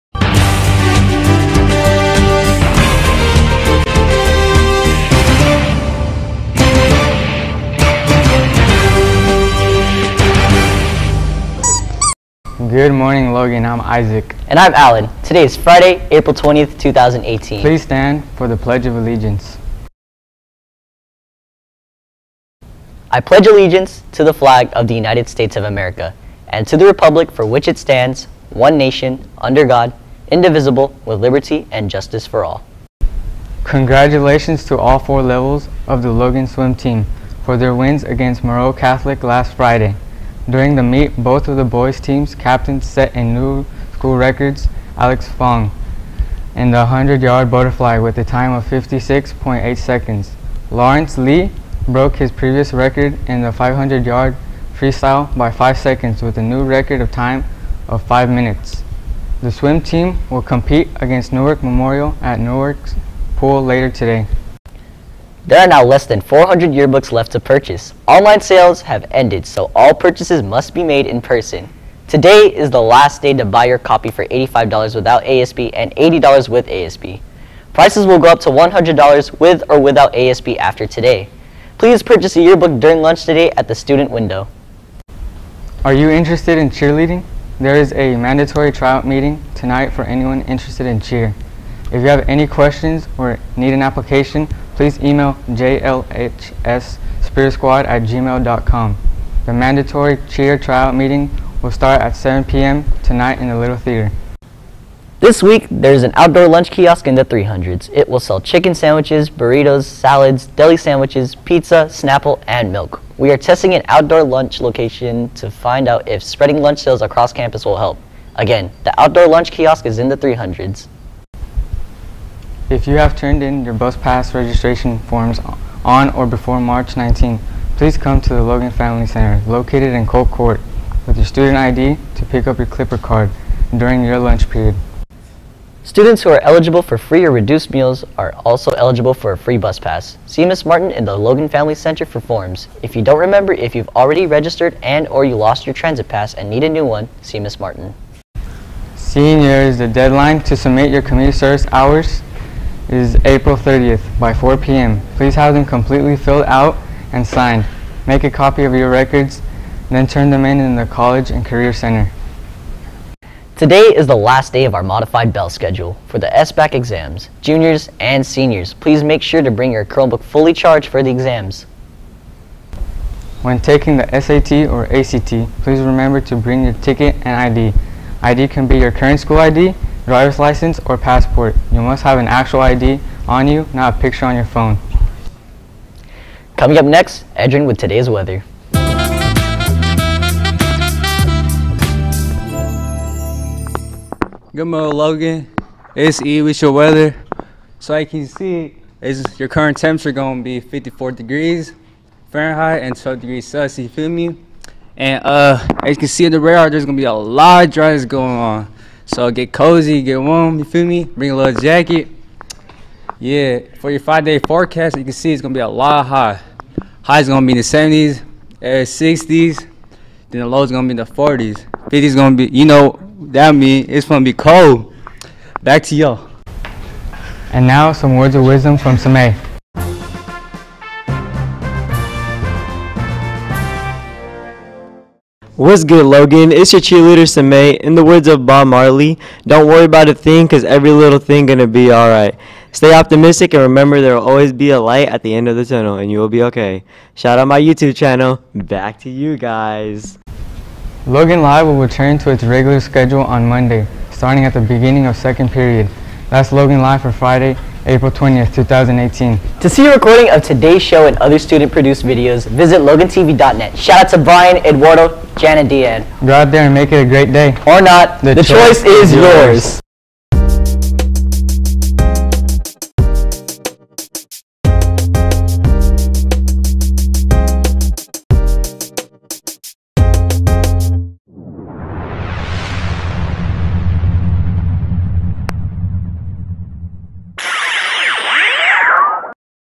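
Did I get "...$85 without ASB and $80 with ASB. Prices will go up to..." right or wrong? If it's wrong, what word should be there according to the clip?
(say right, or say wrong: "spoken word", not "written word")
right.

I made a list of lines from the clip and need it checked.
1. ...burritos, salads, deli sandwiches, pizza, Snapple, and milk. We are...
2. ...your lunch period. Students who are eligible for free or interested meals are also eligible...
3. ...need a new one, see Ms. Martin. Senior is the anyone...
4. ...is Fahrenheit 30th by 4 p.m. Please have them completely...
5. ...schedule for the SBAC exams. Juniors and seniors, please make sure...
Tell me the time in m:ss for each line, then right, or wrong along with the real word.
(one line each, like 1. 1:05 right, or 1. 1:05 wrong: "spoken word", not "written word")
1. 1:49 right
2. 2:14 wrong: "reduced", not "interested"
3. 2:26 wrong: "deadline", not "anyone"
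4. 2:32 wrong: "April", not "Fahrenheit"
5. 2:45 right.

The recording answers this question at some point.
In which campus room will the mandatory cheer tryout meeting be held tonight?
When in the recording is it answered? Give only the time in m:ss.
1:43.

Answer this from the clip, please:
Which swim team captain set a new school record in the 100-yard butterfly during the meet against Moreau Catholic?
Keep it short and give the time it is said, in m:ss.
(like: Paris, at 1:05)
Alex Fong, at 0:44.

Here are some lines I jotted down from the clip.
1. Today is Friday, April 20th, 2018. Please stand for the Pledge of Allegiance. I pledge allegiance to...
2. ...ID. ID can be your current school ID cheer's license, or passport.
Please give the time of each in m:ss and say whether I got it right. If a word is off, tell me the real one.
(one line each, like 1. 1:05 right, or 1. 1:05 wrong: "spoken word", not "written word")
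1. 0:15 right
2. 2:57 wrong: "driver", not "cheer".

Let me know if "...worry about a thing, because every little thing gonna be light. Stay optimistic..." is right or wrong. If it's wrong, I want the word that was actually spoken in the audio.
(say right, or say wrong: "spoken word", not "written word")
wrong: "alright", not "light".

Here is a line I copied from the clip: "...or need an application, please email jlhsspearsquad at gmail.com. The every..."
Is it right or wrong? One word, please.
wrong.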